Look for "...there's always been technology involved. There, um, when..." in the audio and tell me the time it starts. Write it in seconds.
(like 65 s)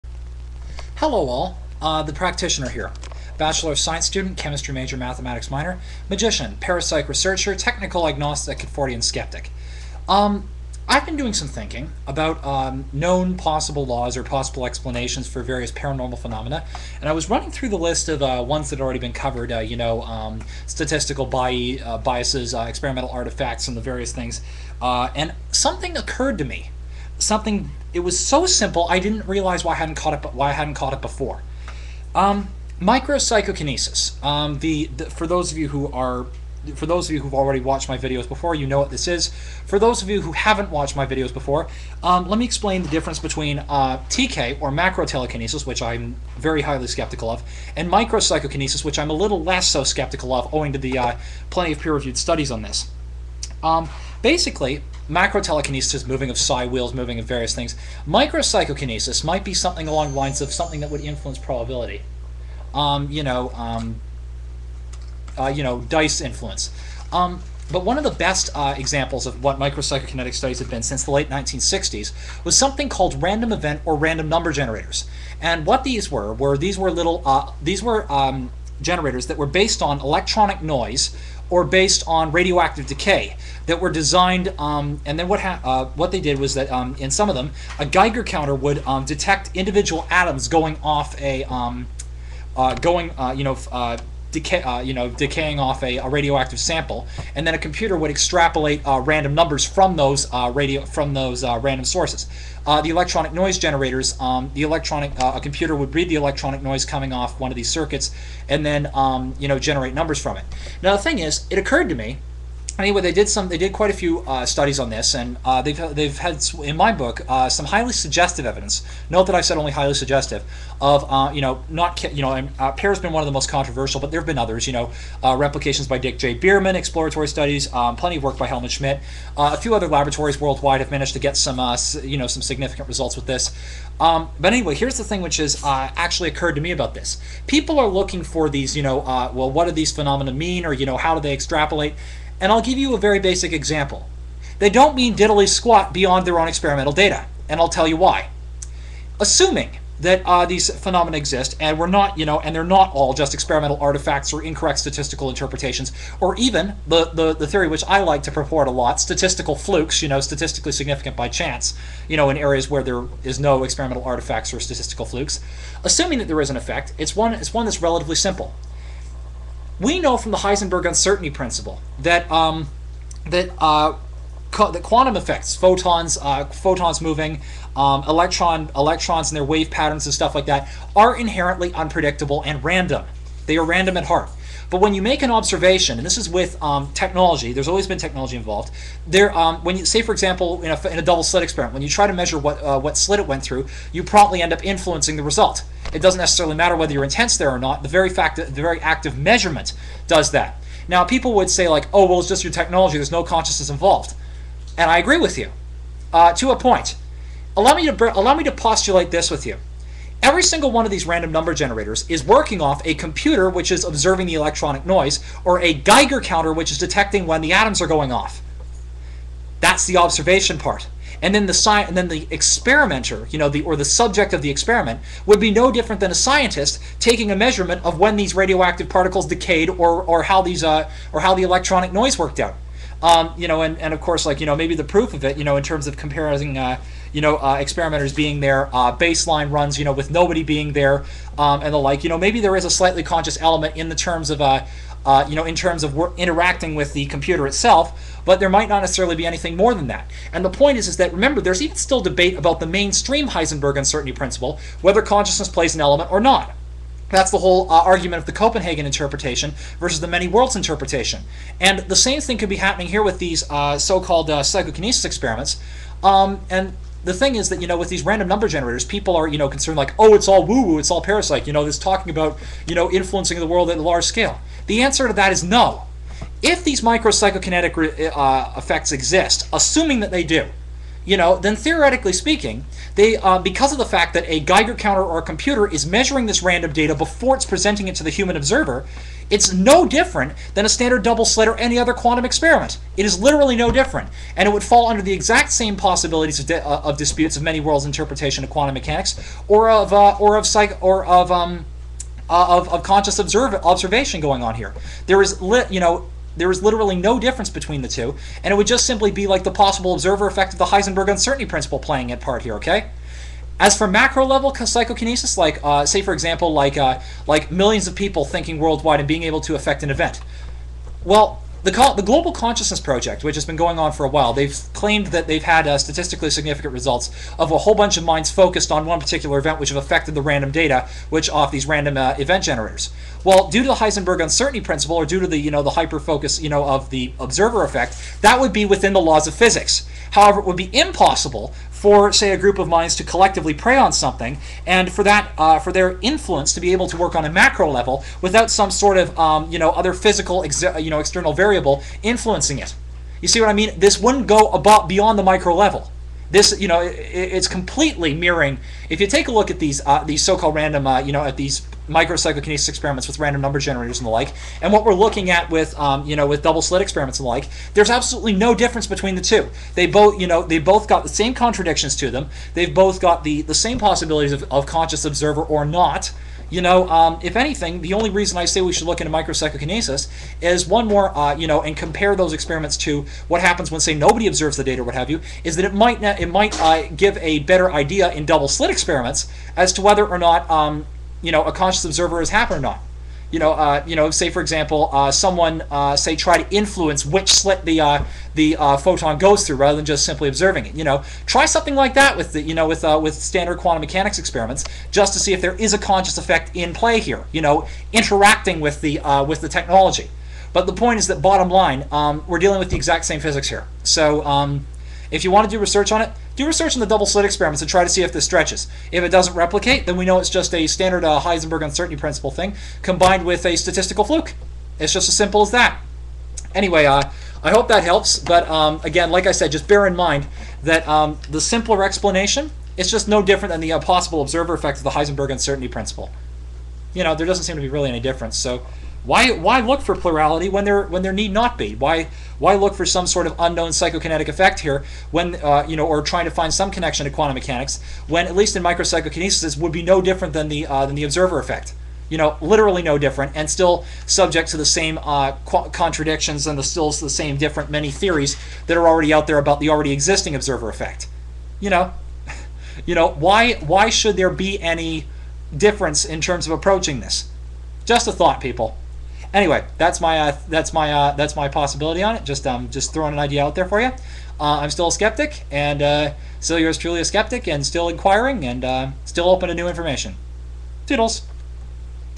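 187 s.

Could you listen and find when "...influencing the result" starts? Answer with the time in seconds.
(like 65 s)
194 s.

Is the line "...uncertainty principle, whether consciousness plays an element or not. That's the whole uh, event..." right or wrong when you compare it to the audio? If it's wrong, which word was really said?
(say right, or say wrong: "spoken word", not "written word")
wrong: "argument", not "event".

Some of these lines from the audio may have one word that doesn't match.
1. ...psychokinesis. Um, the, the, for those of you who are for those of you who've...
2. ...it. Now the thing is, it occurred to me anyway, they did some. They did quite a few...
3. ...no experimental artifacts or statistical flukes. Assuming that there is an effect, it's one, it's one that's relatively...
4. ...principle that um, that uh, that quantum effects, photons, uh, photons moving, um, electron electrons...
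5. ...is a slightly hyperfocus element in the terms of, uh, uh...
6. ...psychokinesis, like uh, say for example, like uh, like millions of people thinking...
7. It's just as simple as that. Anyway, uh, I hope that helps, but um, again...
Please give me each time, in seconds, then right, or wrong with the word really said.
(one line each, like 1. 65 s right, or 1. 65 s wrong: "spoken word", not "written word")
1. 33 s right
2. 110 s right
3. 163 s right
4. 171 s right
5. 242 s wrong: "conscious", not "hyperfocus"
6. 314 s right
7. 424 s right.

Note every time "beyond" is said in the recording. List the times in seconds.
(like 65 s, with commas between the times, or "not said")
145 s, 354 s.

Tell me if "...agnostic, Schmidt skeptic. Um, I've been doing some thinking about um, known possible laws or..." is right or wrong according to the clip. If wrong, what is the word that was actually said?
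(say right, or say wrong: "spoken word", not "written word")
wrong: "Fortean", not "Schmidt".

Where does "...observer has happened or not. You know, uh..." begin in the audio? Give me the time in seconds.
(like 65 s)
391 s.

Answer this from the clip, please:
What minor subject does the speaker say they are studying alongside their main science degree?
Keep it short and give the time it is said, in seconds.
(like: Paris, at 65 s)
Mathematics, at 4 s.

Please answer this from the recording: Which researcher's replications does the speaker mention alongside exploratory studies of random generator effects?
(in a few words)
Dick J. Bierman.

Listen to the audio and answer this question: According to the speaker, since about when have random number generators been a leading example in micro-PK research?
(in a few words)
Late 1960s.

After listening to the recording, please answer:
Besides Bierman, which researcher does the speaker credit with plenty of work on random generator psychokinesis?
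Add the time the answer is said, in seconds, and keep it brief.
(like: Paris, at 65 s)
Helmut Schmidt, at 128 s.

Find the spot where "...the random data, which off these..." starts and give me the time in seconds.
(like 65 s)
330 s.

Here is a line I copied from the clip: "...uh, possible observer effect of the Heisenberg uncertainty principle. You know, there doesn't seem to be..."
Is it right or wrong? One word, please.
right.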